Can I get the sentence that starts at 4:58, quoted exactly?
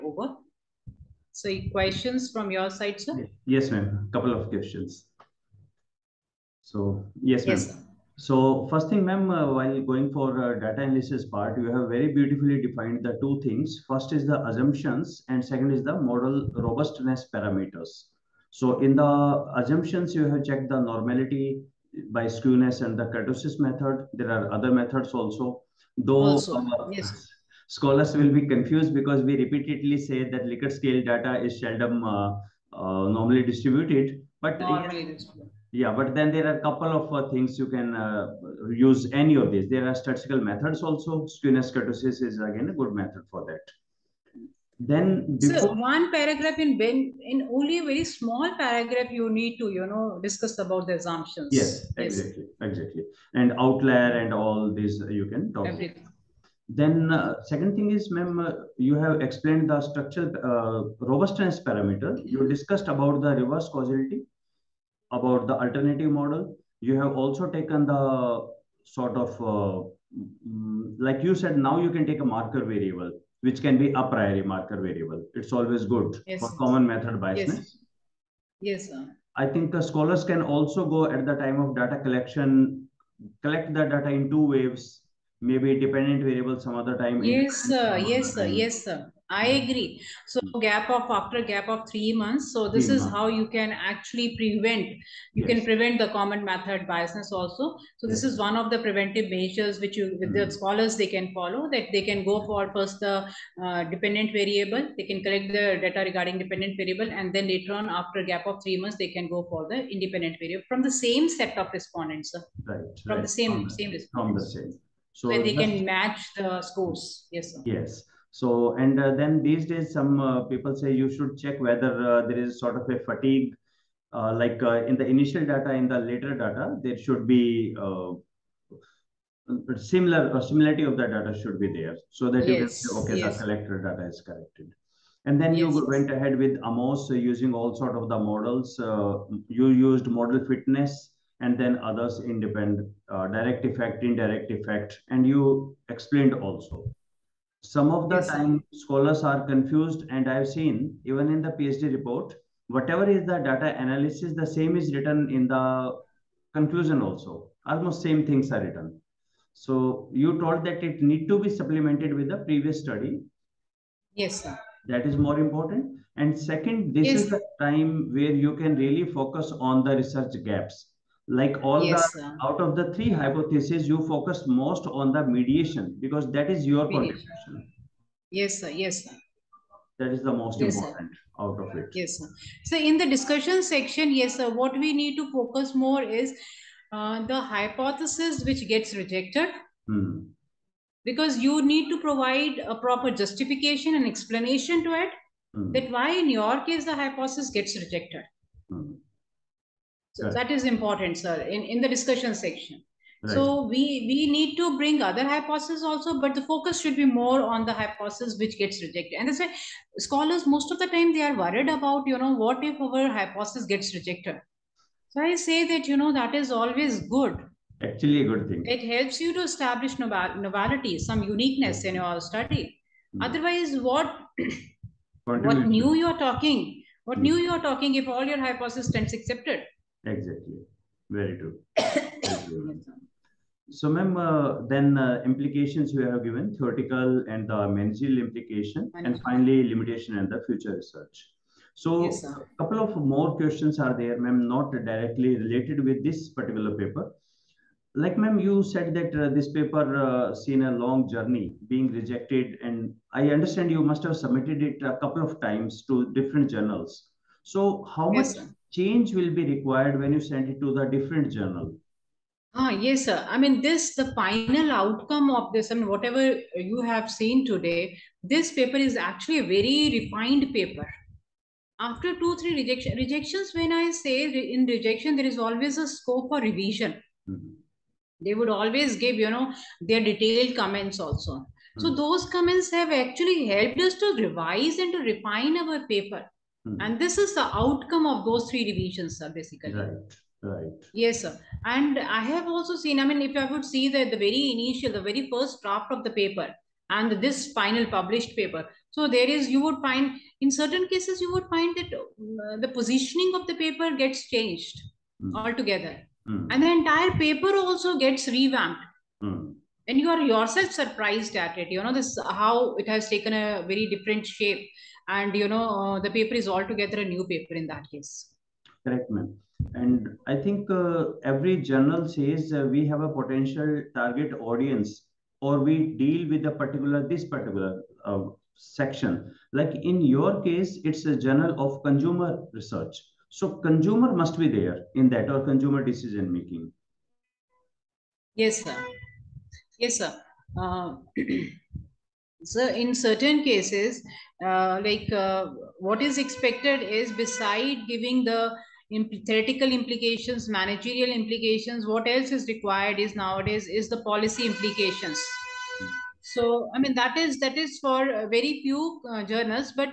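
So there is, you would find, in certain cases, you would find that uh, the positioning of the paper gets changed mm.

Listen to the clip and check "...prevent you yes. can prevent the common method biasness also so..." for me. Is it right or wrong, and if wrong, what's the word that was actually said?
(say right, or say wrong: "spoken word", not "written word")
right.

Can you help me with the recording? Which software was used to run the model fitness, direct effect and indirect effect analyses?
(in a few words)
Amos.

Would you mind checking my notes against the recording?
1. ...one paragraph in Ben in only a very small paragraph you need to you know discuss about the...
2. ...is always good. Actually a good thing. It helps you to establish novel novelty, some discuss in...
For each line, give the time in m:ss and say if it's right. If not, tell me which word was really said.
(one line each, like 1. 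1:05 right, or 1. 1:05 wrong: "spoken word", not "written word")
1. 0:45 right
2. 3:36 wrong: "uniqueness", not "discuss".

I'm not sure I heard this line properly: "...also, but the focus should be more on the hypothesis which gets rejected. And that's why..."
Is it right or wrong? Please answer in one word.
right.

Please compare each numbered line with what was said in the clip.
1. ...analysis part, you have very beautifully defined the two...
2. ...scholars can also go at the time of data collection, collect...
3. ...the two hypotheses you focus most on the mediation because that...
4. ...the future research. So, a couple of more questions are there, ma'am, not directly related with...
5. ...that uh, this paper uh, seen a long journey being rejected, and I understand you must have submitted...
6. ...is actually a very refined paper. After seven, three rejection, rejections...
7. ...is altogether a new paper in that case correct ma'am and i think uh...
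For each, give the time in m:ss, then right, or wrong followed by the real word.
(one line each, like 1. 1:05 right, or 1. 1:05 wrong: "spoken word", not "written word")
1. 0:10 right
2. 1:19 right
3. 2:52 wrong: "three", not "two"
4. 4:00 right
5. 4:08 right
6. 4:28 wrong: "two", not "seven"
7. 5:16 right.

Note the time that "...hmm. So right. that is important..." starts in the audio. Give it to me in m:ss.
3:18.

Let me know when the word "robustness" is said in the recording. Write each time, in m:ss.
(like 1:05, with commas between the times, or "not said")
0:16, 1:00.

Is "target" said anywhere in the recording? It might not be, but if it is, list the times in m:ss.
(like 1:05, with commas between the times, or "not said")
5:23.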